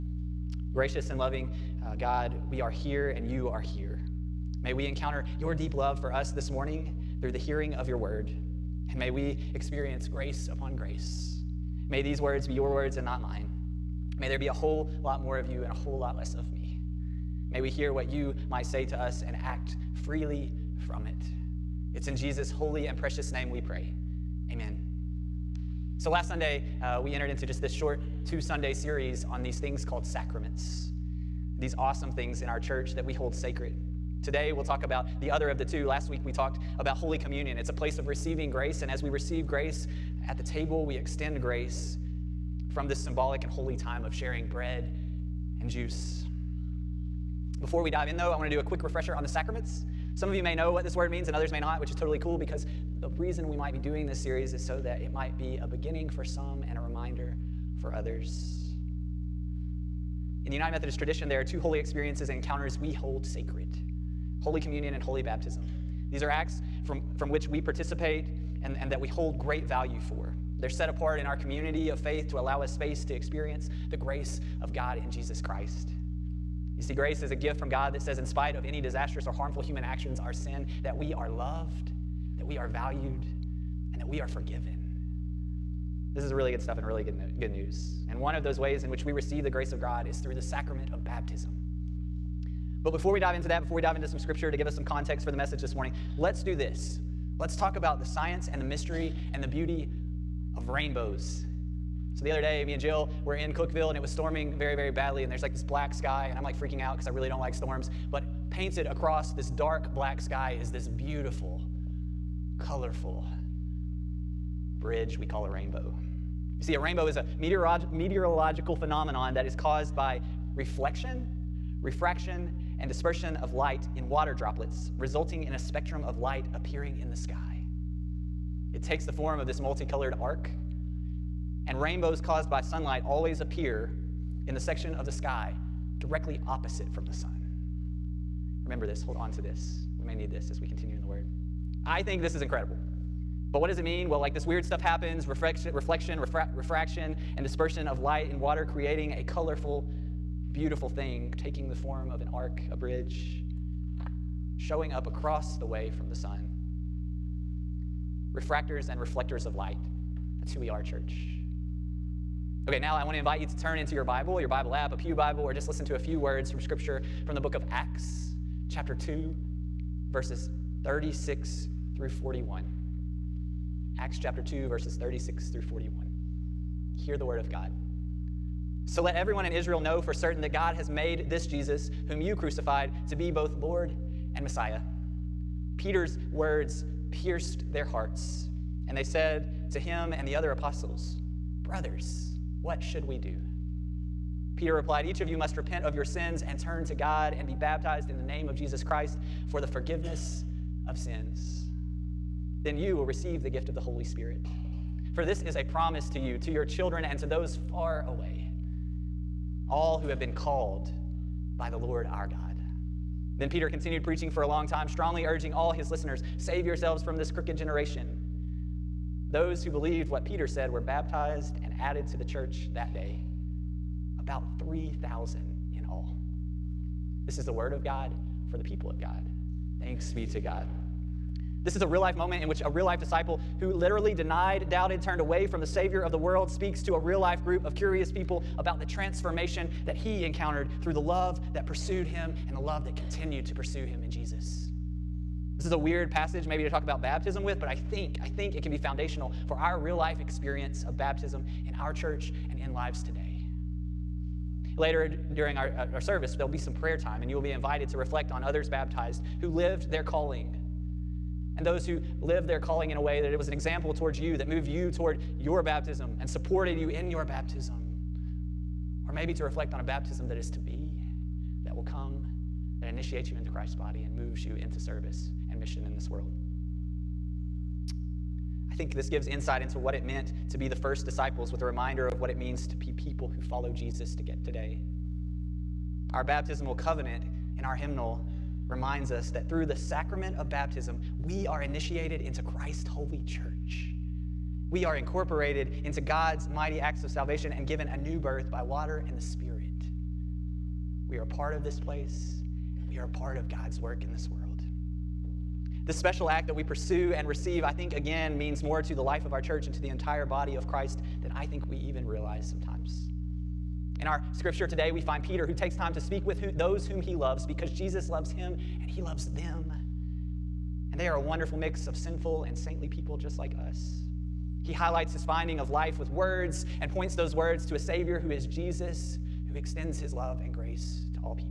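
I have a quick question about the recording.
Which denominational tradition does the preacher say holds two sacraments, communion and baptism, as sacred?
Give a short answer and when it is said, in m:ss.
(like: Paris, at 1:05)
United Methodist, at 1:00.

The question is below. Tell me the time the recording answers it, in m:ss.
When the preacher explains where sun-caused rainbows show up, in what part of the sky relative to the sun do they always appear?
2:15.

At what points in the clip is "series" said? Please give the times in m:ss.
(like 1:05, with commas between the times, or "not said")
0:28, 0:54.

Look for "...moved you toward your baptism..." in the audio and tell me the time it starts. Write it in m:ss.
4:24.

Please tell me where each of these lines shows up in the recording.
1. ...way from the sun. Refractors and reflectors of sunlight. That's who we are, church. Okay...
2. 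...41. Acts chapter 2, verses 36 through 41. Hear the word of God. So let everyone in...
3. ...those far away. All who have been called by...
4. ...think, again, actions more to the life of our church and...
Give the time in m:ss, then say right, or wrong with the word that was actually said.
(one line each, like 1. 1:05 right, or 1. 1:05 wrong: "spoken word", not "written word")
1. 2:35 wrong: "light", not "sunlight"
2. 2:52 right
3. 3:27 right
4. 5:07 wrong: "means", not "actions".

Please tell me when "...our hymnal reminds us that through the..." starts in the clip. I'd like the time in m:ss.
4:47.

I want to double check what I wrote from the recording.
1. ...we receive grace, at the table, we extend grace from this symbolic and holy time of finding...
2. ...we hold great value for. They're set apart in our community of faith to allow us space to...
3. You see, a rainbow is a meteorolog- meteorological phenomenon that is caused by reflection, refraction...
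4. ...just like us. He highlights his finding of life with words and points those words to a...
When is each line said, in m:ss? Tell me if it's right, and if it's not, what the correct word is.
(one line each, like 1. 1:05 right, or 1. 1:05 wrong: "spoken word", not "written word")
1. 0:39 wrong: "sharing", not "finding"
2. 1:09 right
3. 1:56 right
4. 5:23 right.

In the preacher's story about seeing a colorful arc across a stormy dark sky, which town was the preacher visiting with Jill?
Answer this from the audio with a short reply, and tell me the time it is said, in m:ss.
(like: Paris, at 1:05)
Cookeville, at 1:43.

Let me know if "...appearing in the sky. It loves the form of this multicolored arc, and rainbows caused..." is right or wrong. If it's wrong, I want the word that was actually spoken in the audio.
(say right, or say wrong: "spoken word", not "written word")
wrong: "takes", not "loves".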